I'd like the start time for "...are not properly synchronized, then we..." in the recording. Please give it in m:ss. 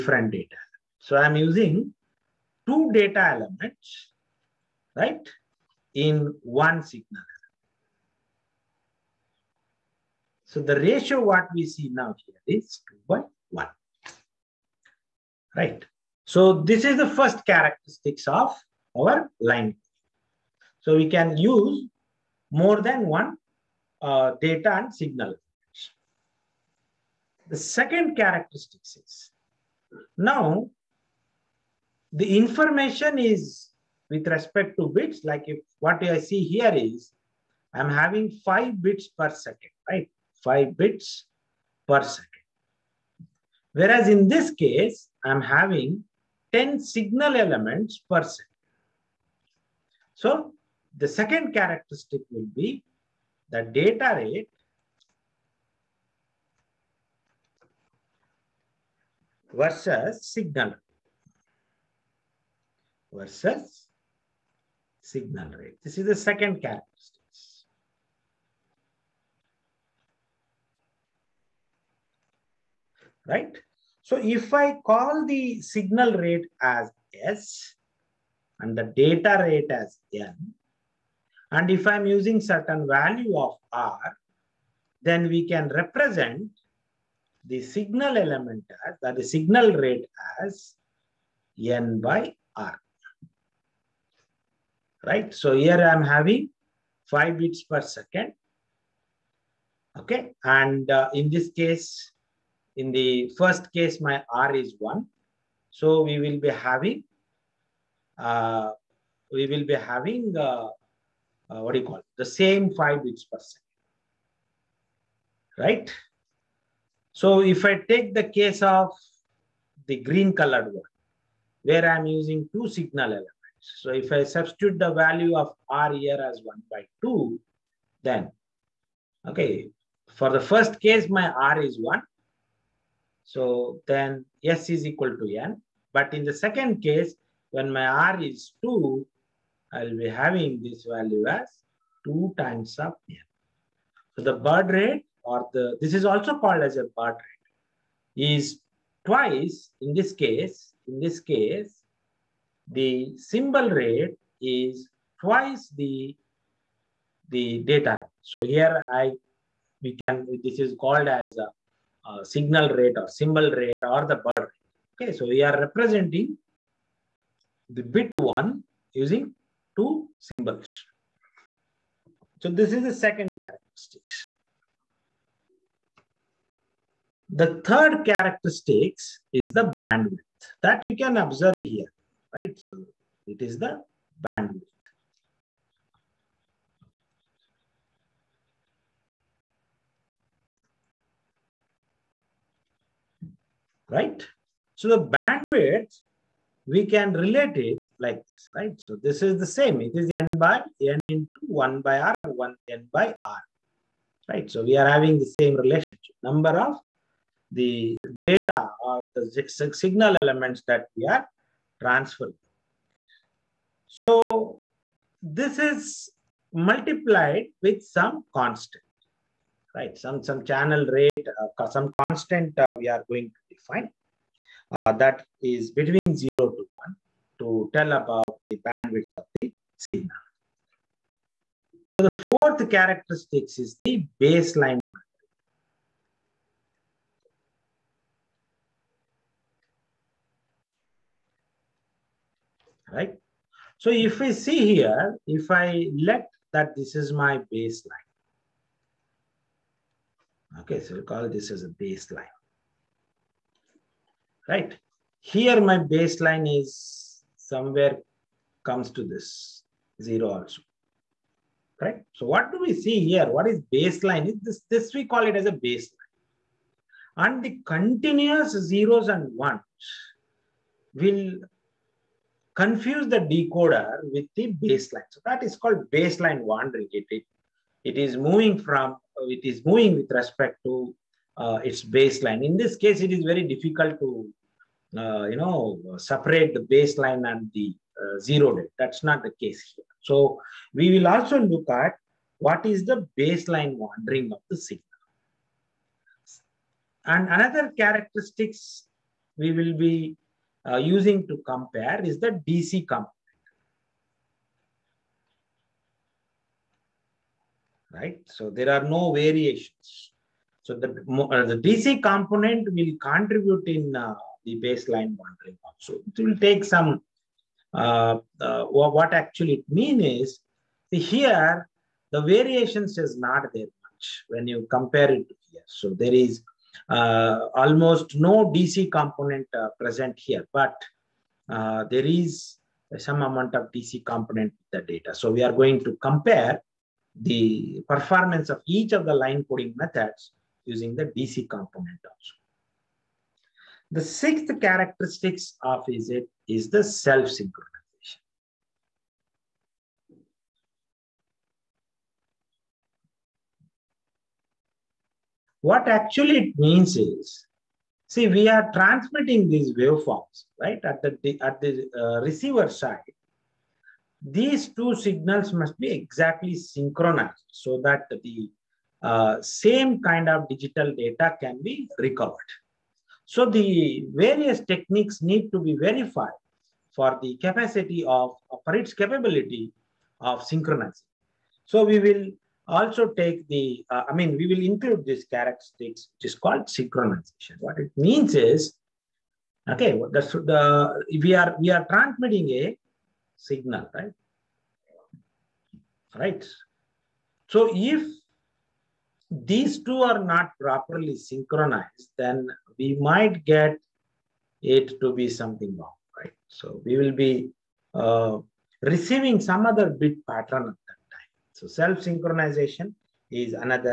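6:40.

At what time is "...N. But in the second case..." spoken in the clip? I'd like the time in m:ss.
2:15.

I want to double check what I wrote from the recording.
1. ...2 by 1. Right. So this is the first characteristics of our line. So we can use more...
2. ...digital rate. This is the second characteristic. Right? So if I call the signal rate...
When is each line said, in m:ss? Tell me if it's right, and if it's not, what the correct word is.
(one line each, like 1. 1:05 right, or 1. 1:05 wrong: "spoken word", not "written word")
1. 0:12 right
2. 1:05 wrong: "signal", not "digital".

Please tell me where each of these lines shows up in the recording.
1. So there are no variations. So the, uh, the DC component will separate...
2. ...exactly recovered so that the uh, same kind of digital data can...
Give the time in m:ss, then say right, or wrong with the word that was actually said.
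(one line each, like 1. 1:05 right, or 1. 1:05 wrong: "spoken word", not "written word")
1. 5:08 wrong: "contribute", not "separate"
2. 6:05 wrong: "synchronized", not "recovered".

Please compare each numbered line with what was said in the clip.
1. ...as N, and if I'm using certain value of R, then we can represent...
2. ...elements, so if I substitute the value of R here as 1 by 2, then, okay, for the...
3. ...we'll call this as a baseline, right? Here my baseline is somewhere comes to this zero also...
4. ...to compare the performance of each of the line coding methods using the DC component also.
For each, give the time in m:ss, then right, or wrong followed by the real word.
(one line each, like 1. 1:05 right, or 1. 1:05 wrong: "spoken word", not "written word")
1. 1:19 right
2. 2:03 right
3. 4:10 right
4. 5:35 right.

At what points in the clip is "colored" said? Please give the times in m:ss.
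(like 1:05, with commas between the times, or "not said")
2:00.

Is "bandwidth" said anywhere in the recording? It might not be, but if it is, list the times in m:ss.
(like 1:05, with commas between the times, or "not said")
2:59, 3:04, 3:15, 3:48.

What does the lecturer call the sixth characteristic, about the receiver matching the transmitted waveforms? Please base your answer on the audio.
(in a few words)
Self-synchronous.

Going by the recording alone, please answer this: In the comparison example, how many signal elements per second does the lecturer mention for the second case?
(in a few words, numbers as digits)
10.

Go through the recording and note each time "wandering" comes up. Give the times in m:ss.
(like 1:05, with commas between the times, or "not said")
4:36, 4:53.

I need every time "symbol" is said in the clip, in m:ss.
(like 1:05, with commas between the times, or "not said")
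2:33, 2:43, 2:50.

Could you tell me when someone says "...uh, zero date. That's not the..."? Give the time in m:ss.
4:48.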